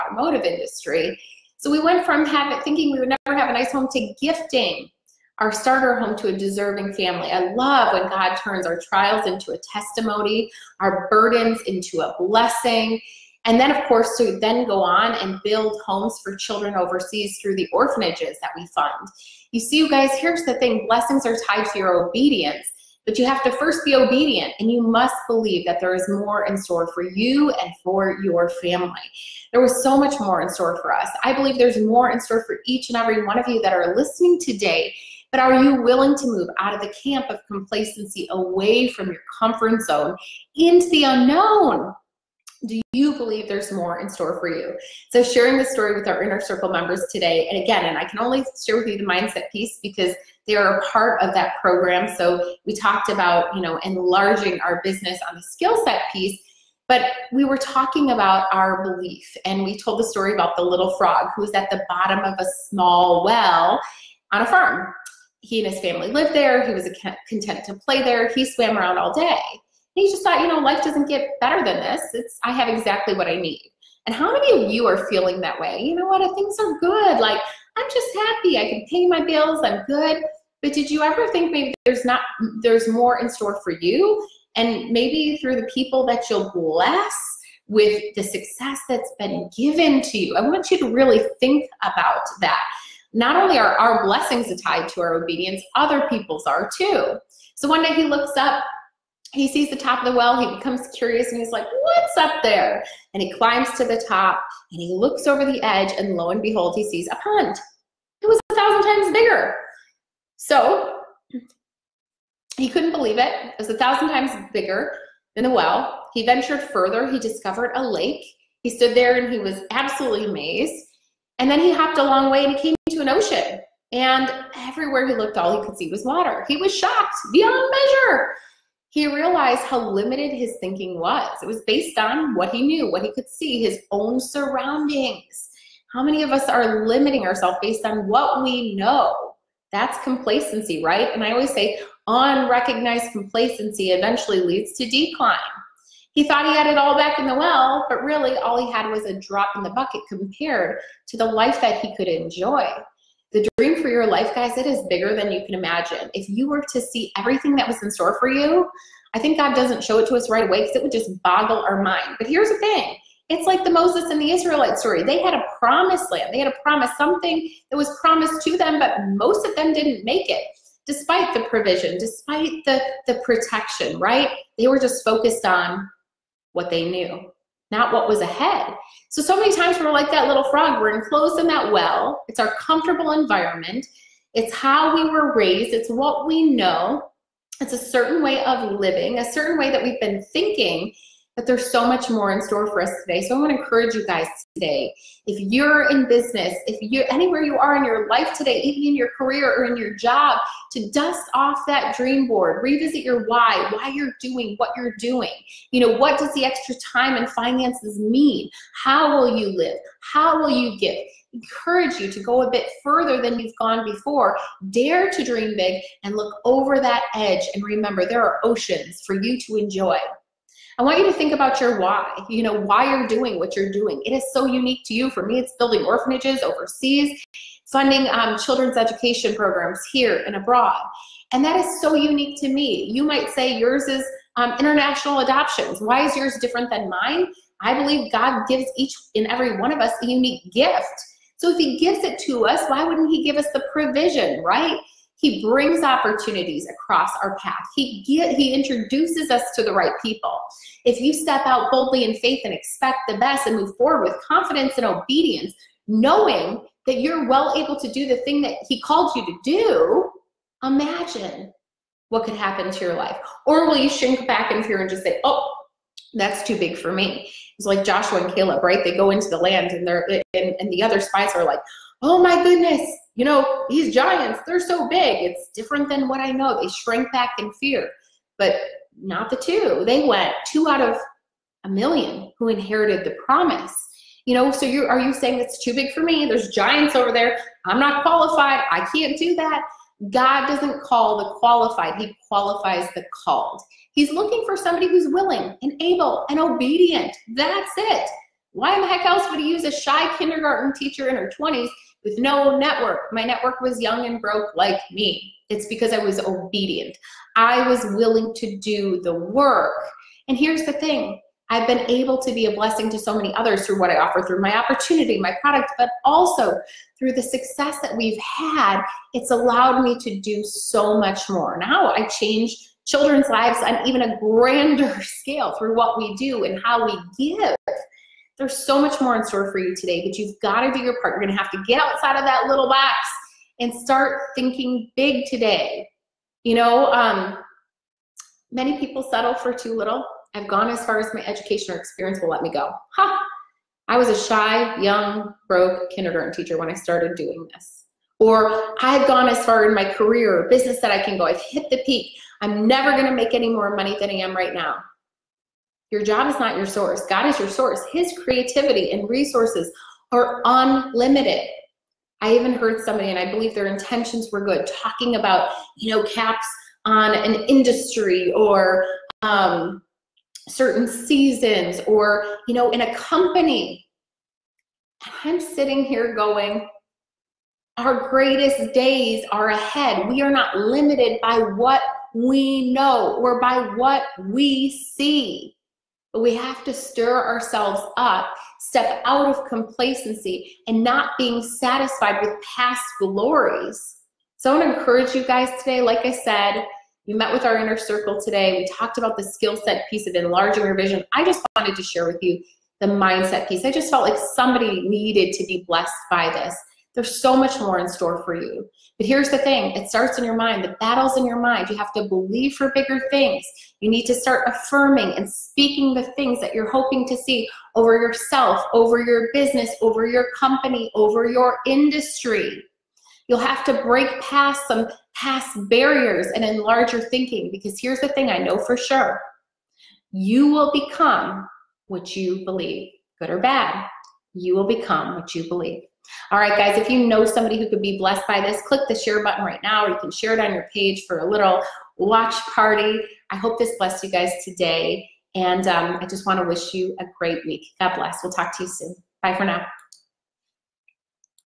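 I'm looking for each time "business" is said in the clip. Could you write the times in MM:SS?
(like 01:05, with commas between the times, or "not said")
00:54, 03:16, 05:50, 06:59.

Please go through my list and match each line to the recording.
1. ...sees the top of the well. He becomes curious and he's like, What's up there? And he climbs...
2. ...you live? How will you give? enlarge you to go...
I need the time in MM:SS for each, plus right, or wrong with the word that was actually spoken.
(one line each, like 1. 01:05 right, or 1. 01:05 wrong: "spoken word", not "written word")
1. 01:39 right
2. 03:29 wrong: "encourage", not "enlarge".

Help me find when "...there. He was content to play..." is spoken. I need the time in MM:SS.
01:06.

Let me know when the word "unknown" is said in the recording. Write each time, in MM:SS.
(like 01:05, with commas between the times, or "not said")
00:41.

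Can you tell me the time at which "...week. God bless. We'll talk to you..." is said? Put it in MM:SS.
07:27.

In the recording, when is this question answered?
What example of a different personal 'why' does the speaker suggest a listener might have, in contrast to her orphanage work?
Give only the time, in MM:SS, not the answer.
03:54.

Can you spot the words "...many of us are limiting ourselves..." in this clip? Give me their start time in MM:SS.
02:16.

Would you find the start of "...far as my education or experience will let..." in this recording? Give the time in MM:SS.
05:40.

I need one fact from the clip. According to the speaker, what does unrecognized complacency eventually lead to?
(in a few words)
decline.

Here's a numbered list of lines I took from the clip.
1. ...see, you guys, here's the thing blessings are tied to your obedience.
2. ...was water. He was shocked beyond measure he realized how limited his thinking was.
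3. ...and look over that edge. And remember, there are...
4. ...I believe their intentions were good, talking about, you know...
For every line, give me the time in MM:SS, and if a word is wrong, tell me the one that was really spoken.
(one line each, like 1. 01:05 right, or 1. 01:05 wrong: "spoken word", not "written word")
1. 00:19 right
2. 02:05 right
3. 03:36 right
4. 06:03 right.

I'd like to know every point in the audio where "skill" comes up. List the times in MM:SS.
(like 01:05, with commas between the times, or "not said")
00:55, 06:39.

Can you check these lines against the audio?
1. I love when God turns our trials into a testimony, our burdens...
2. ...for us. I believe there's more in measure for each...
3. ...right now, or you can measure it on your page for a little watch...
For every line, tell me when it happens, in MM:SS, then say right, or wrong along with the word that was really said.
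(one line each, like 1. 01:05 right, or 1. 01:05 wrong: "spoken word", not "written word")
1. 00:07 right
2. 00:30 wrong: "store", not "measure"
3. 07:19 wrong: "share", not "measure".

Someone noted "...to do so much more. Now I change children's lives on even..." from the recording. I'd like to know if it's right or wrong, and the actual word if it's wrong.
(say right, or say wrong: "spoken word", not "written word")
right.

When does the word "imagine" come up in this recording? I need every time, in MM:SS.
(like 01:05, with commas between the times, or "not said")
02:35, 04:20.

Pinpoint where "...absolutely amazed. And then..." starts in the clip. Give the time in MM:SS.
01:59.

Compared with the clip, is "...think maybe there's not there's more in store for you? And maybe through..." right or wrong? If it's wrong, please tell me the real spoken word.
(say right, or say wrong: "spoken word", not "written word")
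right.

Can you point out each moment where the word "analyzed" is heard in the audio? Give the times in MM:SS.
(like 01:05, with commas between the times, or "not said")
not said.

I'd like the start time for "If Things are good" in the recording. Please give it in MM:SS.
01:16.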